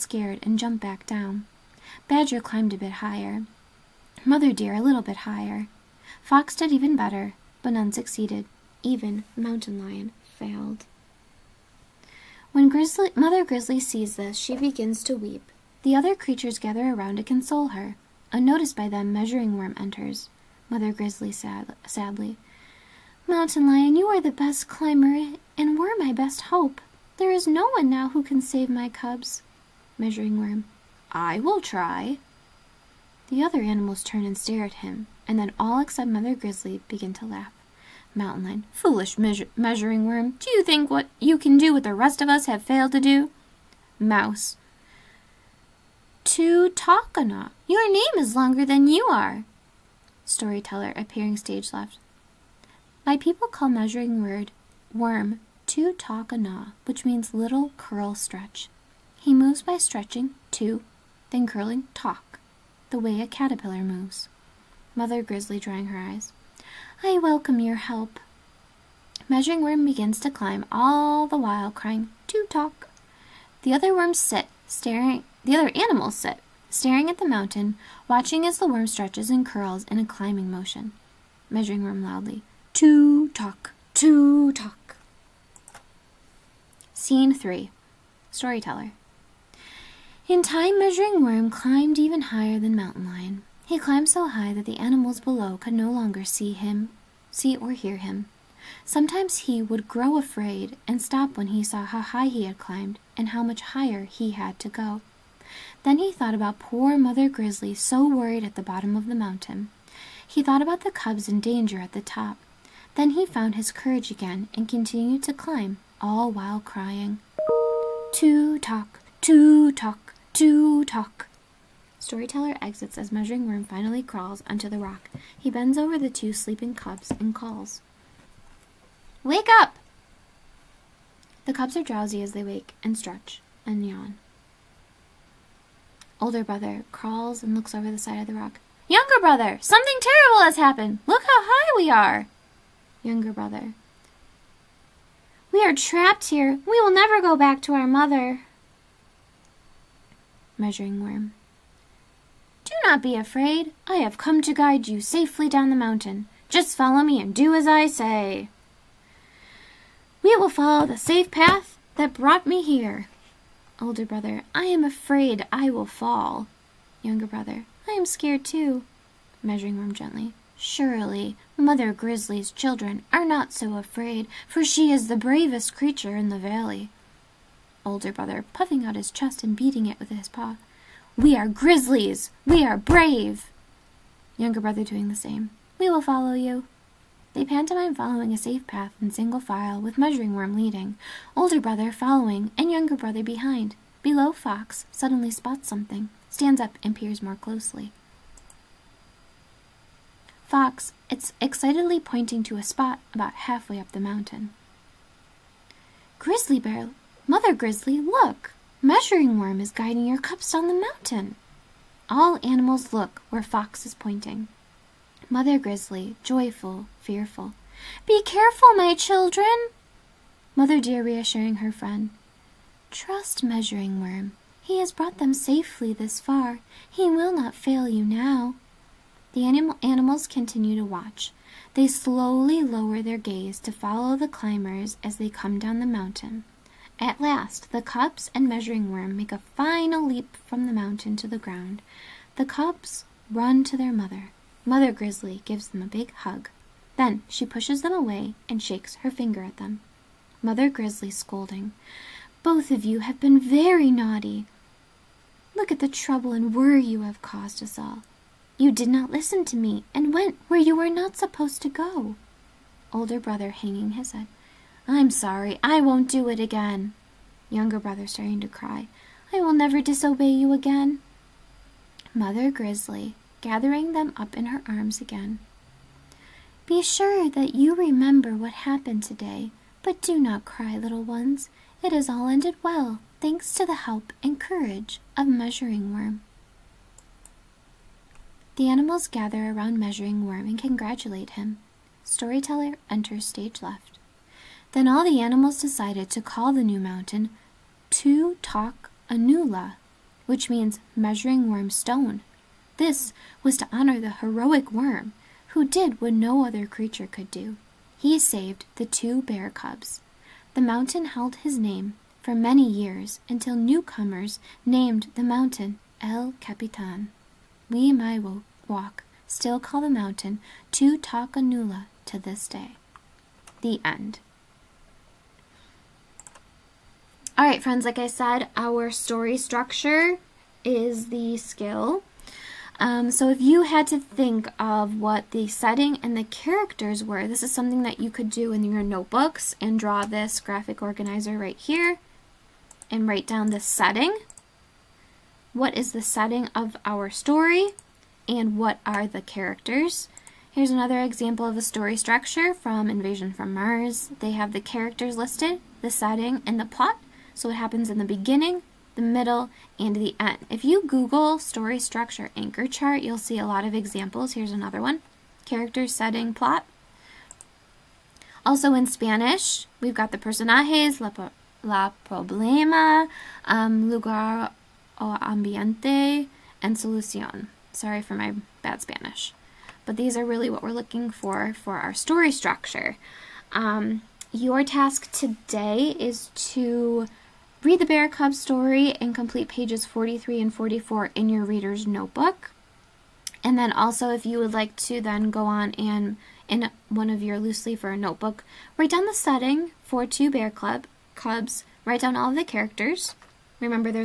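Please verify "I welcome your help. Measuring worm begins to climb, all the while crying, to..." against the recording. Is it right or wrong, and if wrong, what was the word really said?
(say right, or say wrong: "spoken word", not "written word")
right.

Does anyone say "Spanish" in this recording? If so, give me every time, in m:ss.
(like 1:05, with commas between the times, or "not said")
6:08, 6:18.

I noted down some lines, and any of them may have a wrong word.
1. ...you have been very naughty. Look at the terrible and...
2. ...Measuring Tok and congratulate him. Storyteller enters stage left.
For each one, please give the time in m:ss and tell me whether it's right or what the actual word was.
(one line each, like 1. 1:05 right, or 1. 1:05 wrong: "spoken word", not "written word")
1. 4:12 wrong: "trouble", not "terrible"
2. 4:49 wrong: "Worm", not "Tok".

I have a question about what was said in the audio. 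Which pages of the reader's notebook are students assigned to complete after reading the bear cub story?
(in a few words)
43 and 44.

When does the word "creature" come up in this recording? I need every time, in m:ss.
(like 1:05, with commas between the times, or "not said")
0:16, 2:55, 5:06.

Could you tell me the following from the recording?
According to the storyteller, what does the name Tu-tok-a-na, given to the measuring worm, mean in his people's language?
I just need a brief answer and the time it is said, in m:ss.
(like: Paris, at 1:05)
little curl stretch, at 0:57.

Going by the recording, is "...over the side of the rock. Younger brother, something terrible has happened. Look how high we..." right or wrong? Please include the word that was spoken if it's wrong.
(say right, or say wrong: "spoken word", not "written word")
right.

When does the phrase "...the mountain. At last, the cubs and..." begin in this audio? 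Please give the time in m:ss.
3:55.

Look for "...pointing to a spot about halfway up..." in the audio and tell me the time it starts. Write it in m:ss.
3:21.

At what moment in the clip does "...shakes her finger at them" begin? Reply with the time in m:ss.
4:08.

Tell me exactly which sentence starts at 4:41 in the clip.
It has all ended well, thanks to the help and courage of Measuring Worm.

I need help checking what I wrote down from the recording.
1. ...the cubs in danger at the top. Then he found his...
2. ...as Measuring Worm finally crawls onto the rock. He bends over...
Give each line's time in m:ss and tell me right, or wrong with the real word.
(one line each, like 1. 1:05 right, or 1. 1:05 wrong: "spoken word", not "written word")
1. 1:50 right
2. 2:02 right.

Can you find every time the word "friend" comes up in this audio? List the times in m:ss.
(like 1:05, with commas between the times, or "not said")
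3:41, 5:27.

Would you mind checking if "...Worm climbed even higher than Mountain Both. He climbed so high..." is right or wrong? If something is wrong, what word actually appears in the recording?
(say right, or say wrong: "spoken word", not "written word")
wrong: "Lion", not "Both".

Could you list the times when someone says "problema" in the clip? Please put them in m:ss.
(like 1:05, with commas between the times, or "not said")
6:12.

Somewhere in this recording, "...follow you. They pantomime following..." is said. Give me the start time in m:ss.
3:06.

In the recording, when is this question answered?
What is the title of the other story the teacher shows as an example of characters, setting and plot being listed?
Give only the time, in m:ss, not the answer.
5:52.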